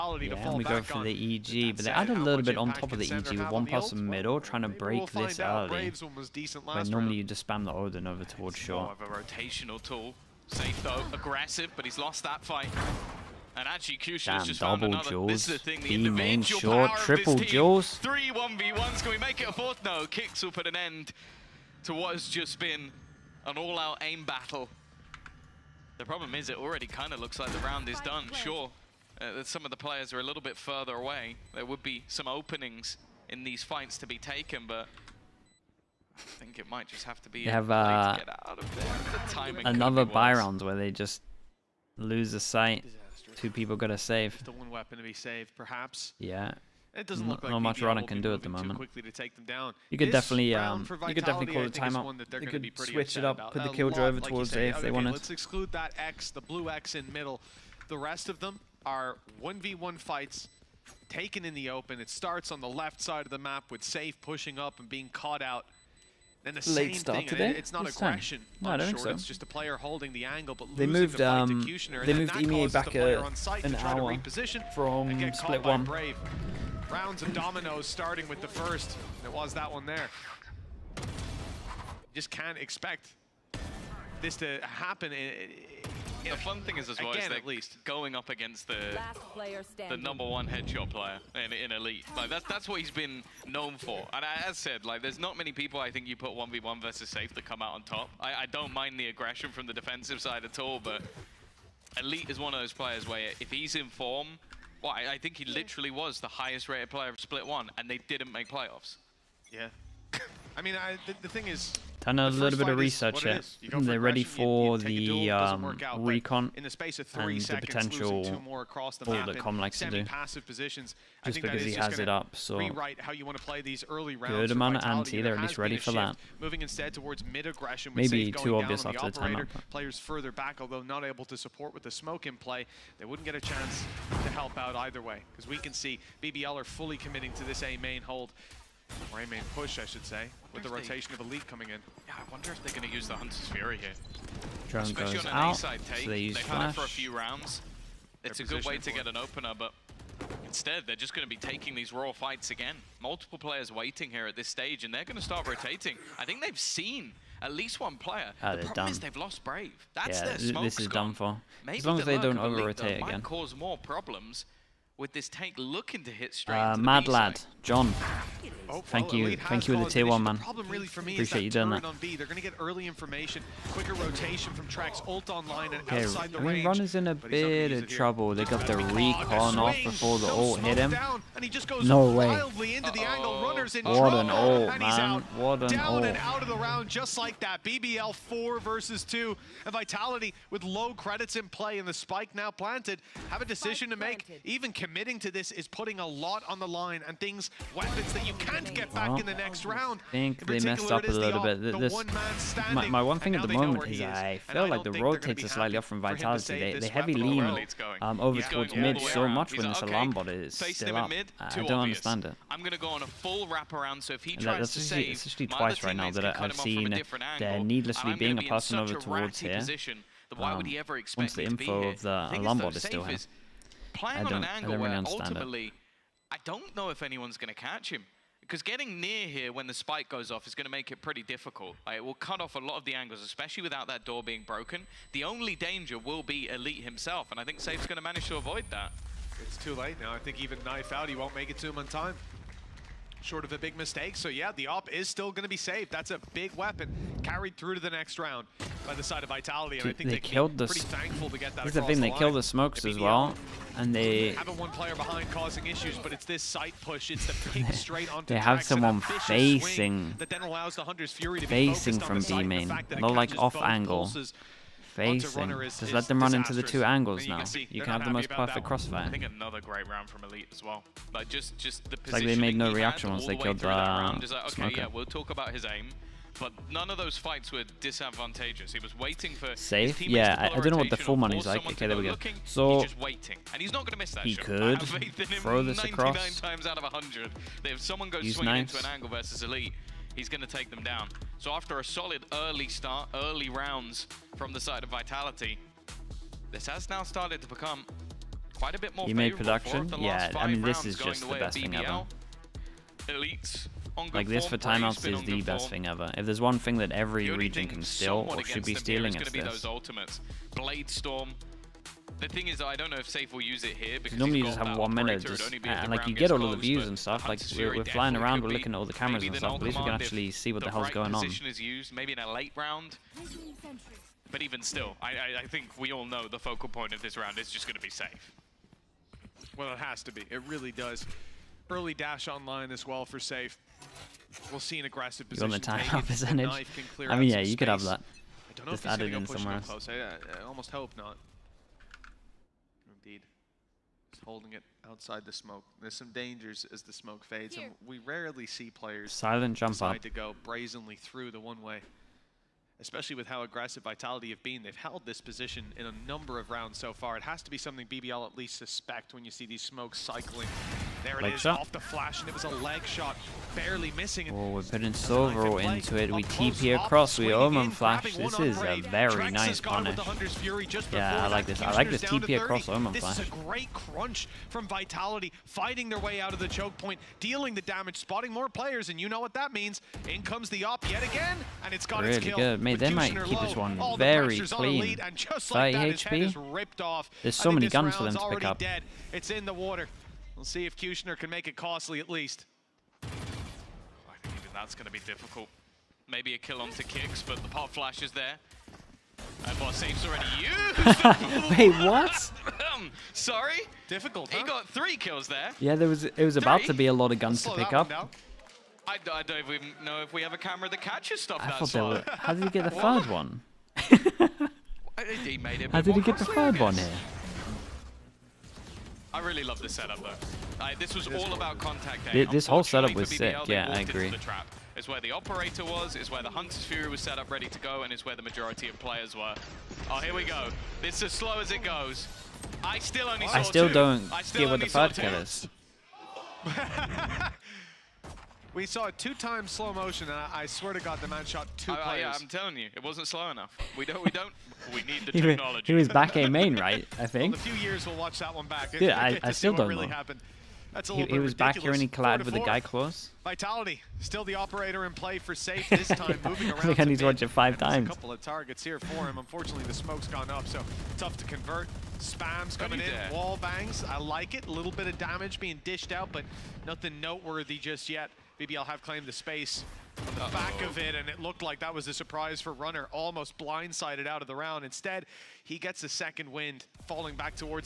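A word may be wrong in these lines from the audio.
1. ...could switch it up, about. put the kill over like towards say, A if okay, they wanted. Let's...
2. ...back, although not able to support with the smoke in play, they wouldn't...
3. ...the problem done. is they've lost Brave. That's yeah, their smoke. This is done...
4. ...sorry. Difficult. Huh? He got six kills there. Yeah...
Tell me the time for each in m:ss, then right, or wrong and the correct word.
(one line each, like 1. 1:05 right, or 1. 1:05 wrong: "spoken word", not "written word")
1. 0:52 right
2. 2:10 right
3. 2:38 right
4. 6:43 wrong: "three", not "six".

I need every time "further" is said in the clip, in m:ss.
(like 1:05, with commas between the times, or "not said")
0:30, 2:09.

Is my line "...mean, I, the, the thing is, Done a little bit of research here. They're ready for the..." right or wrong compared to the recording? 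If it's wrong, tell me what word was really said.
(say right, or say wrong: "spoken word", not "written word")
right.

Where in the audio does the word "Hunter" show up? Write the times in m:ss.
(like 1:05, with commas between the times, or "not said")
2:23, 4:20, 7:06.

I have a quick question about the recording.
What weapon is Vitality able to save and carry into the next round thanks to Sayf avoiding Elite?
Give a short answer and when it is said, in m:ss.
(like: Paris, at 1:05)
AWP, at 4:04.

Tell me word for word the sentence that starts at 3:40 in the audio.
Why um, would he ever expect Once the info of the alarm is still here playing on an angle where ultimately, it.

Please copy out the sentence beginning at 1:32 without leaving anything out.
Like that's that's what he's been known for.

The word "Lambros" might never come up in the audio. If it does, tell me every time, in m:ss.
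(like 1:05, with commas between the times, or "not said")
not said.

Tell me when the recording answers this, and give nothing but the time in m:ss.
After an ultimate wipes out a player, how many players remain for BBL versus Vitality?
3:07.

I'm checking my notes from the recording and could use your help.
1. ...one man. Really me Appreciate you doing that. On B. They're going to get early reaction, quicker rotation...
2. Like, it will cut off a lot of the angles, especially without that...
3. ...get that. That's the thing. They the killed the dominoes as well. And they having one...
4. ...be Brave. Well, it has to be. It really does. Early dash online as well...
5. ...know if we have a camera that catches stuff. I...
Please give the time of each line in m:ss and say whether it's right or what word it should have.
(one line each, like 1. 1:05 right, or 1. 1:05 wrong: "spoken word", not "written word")
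1. 2:50 wrong: "information", not "reaction"
2. 3:51 right
3. 4:11 wrong: "smokes", not "dominoes"
4. 5:27 wrong: "Sayf", not "Brave"
5. 6:49 right.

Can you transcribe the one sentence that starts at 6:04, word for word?
Oh, we're putting silver into it.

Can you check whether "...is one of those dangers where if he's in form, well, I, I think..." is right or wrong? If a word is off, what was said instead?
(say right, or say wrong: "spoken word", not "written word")
wrong: "players", not "dangers".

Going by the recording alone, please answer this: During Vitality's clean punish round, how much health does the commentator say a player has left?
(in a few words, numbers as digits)
30 HP.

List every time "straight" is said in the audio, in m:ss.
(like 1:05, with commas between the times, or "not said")
2:46, 4:17.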